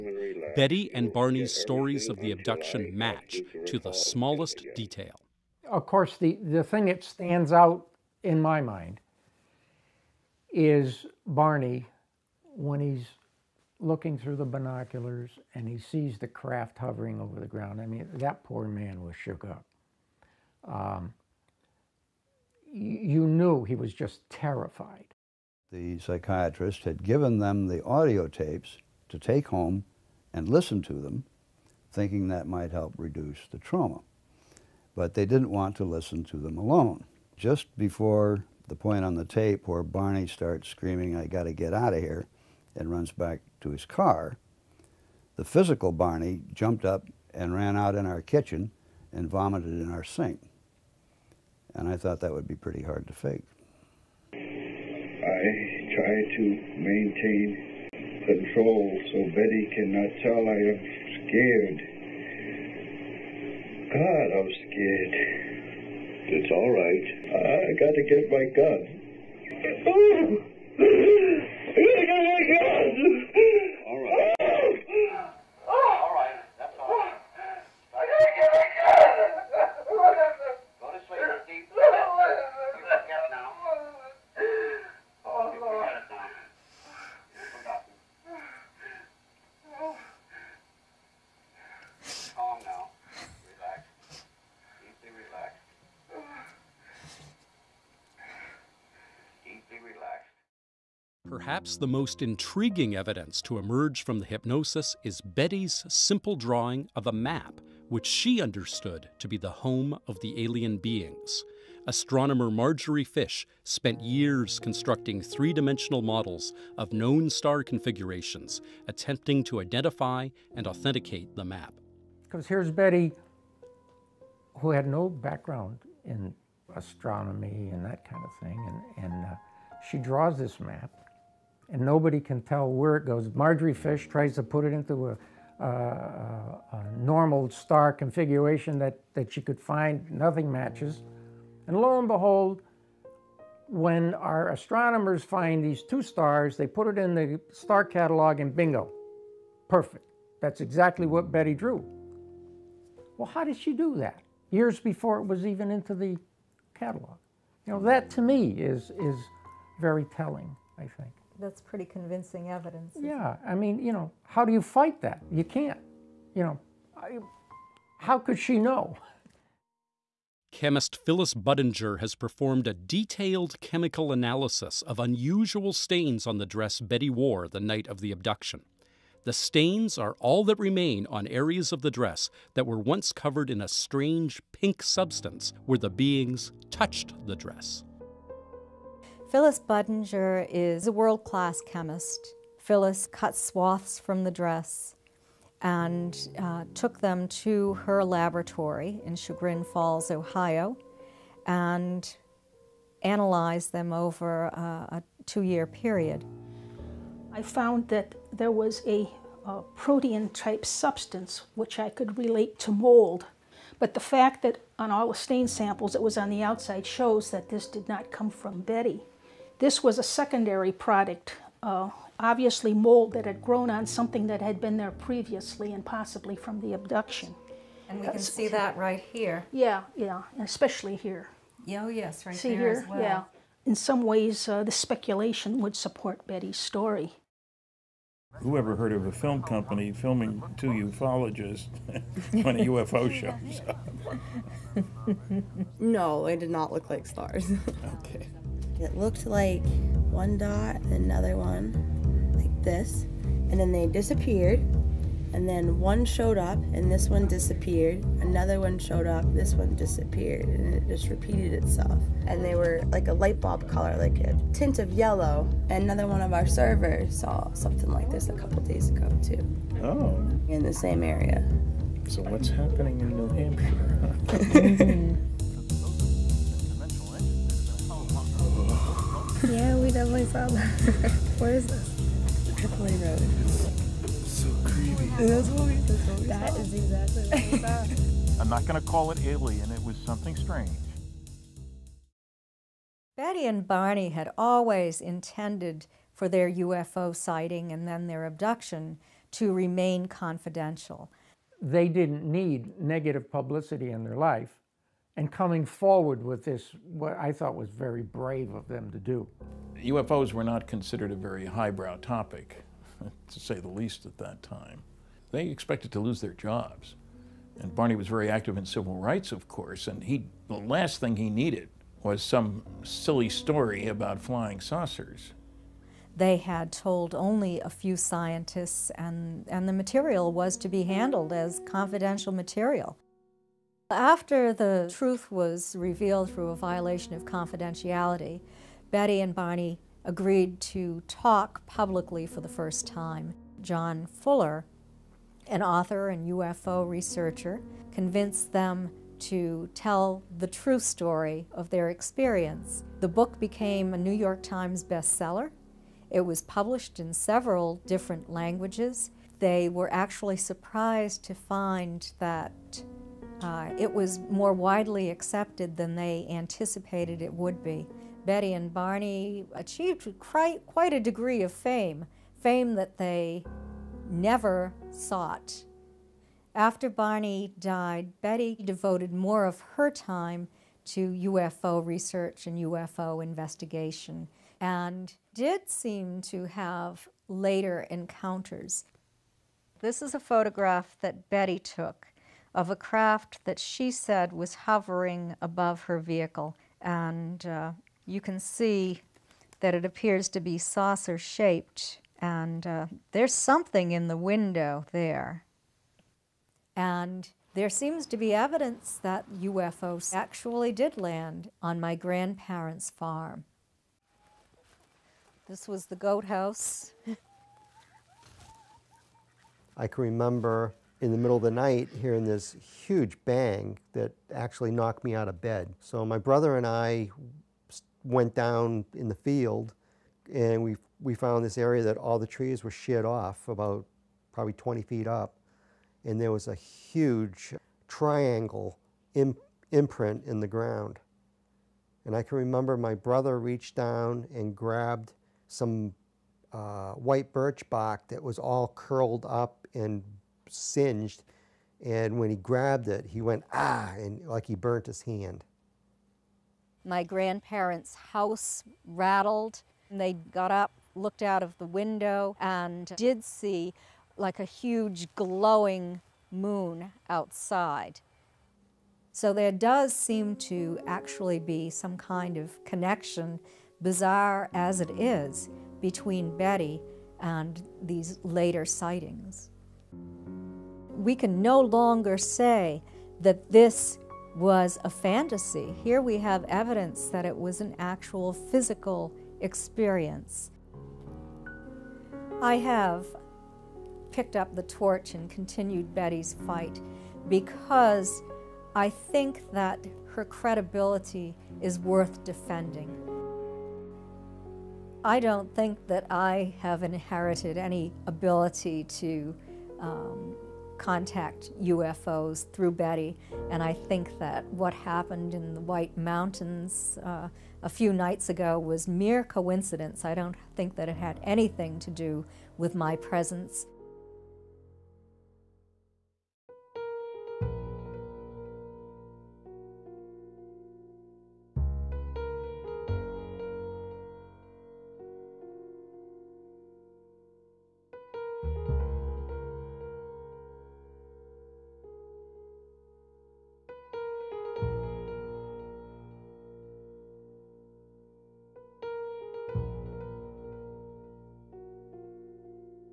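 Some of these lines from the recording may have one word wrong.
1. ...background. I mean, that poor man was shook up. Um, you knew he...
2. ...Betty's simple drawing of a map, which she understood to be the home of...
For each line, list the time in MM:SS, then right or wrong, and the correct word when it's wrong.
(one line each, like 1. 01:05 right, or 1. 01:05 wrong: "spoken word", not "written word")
1. 00:17 wrong: "ground", not "background"
2. 01:45 right.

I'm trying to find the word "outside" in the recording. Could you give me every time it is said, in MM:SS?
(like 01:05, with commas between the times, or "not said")
03:36, 07:47.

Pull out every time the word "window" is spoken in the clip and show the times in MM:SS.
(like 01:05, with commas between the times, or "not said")
06:44, 07:41.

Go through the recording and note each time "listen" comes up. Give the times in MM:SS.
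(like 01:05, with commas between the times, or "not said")
00:30, 00:35.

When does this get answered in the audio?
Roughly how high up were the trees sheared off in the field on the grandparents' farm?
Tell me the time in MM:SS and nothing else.
07:14.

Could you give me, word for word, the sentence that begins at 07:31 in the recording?
And when he grabbed it, he went, ah, and like he burnt his hand.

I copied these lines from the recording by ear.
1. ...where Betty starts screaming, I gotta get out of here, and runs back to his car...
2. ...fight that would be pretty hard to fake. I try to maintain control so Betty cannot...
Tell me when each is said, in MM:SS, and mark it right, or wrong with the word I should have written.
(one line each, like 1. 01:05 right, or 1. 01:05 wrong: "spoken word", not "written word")
1. 00:39 wrong: "Barney", not "Betty"
2. 00:51 wrong: "thought", not "fight".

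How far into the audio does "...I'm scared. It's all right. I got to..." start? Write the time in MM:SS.
01:04.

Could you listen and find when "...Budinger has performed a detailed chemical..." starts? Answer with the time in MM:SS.
02:51.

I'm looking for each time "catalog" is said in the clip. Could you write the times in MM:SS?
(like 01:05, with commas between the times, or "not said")
02:27, 02:36.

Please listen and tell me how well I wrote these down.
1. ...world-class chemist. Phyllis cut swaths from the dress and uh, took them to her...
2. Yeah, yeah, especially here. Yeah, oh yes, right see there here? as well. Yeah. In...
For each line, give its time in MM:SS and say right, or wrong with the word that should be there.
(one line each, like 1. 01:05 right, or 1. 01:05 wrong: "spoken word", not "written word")
1. 03:10 right
2. 03:49 right.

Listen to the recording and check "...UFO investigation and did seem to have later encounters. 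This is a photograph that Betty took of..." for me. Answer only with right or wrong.
right.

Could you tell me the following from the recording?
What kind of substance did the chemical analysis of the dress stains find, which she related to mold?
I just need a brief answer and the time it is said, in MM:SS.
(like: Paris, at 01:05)
Protein-type substance, at 03:29.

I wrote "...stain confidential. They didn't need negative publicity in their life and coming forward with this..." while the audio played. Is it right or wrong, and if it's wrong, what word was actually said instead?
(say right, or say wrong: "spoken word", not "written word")
wrong: "remain", not "stain".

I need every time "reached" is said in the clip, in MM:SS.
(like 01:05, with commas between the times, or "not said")
07:23.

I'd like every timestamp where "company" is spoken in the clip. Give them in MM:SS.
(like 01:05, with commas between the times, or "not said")
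03:59.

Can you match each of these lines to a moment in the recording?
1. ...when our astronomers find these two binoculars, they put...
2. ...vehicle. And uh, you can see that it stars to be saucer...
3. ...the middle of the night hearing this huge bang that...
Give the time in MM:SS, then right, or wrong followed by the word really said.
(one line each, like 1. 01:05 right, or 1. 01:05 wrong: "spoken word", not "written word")
1. 02:23 wrong: "stars", not "binoculars"
2. 06:35 wrong: "appears", not "stars"
3. 07:01 right.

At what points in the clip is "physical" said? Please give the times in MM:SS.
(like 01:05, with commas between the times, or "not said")
00:45, 08:08.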